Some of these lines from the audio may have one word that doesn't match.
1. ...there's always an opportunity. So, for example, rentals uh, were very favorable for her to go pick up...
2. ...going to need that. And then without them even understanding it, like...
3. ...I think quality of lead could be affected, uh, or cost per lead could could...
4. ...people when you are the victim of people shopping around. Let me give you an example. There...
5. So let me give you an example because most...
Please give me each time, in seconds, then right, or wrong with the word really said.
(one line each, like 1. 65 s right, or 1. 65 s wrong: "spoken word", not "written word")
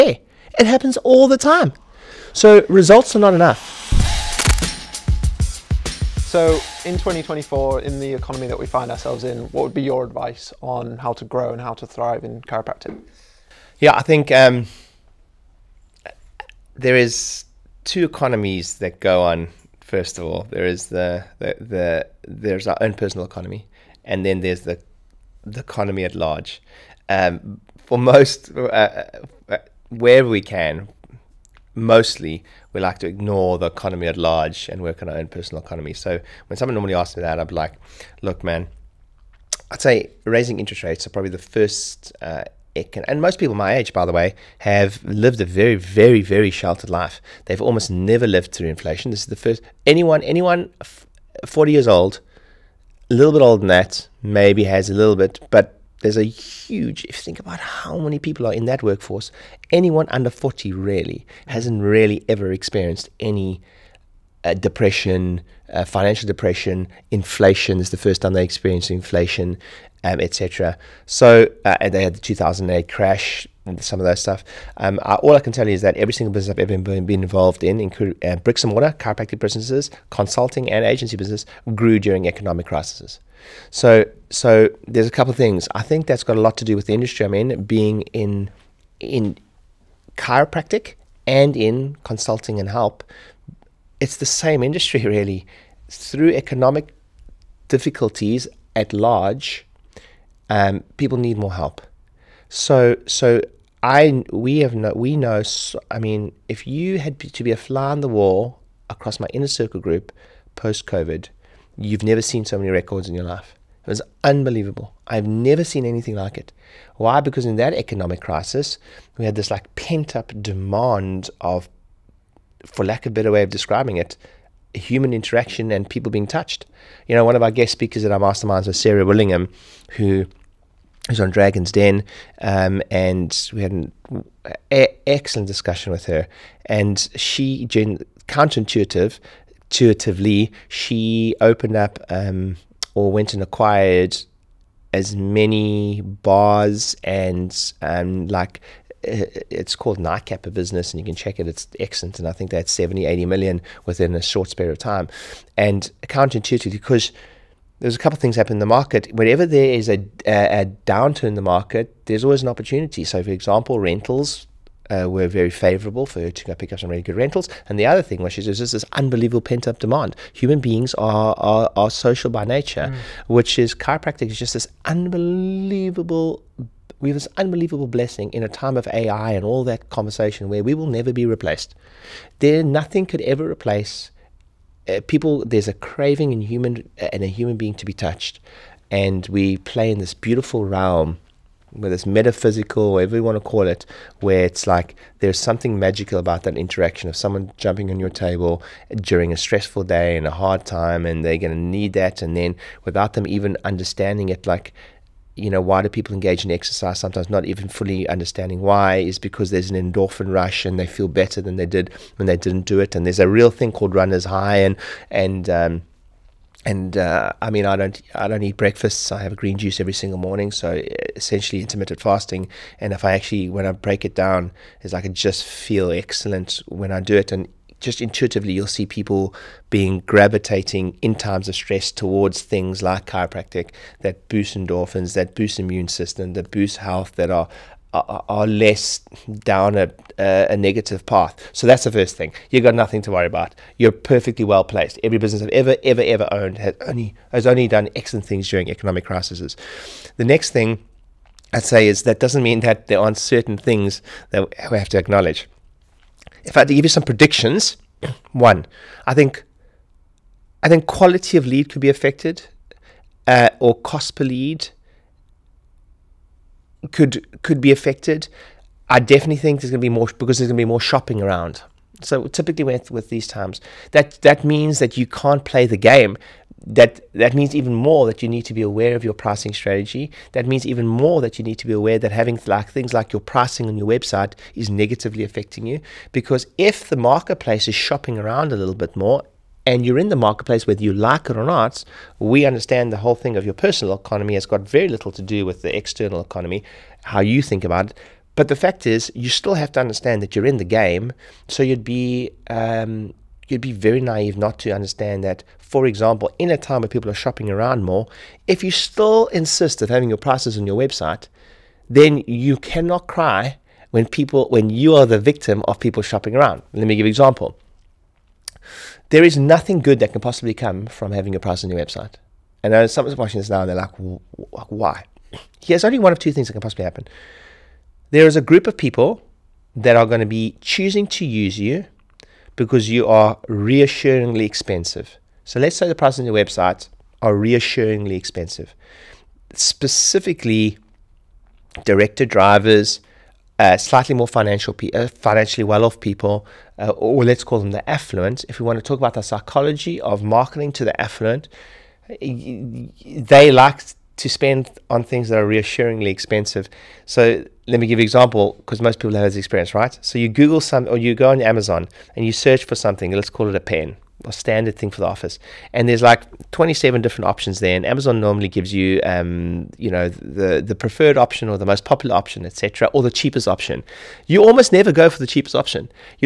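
1. 162 s right
2. 201 s right
3. 260 s right
4. 314 s right
5. 357 s right.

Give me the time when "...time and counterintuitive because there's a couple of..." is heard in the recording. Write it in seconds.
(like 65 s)
154 s.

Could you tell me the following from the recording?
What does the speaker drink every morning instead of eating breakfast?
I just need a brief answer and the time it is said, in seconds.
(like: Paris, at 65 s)
Green juice, at 219 s.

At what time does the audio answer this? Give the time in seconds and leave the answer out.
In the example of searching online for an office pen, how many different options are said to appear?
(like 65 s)
366 s.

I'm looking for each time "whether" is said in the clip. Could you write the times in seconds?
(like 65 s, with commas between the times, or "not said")
191 s, 290 s.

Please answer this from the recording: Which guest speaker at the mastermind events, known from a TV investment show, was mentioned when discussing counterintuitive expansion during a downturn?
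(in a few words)
Sarah Willingham.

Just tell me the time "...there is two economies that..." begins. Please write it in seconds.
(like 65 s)
16 s.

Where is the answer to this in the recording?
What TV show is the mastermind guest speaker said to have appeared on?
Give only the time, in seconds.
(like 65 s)
131 s.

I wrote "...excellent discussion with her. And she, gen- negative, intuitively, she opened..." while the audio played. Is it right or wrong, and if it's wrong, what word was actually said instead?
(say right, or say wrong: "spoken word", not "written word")
wrong: "counterintuitive", not "negative".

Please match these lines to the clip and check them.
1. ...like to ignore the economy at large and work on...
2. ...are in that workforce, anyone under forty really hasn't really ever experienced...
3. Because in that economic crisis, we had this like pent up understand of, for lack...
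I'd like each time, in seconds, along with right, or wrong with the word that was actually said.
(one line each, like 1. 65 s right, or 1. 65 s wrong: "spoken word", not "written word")
1. 32 s right
2. 58 s right
3. 117 s wrong: "demand", not "understand".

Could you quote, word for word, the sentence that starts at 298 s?
But the fact is, you still have to understand that you're in the game.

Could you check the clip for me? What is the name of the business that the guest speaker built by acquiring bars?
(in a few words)
Nightcap.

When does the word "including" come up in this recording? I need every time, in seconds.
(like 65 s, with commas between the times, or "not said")
77 s.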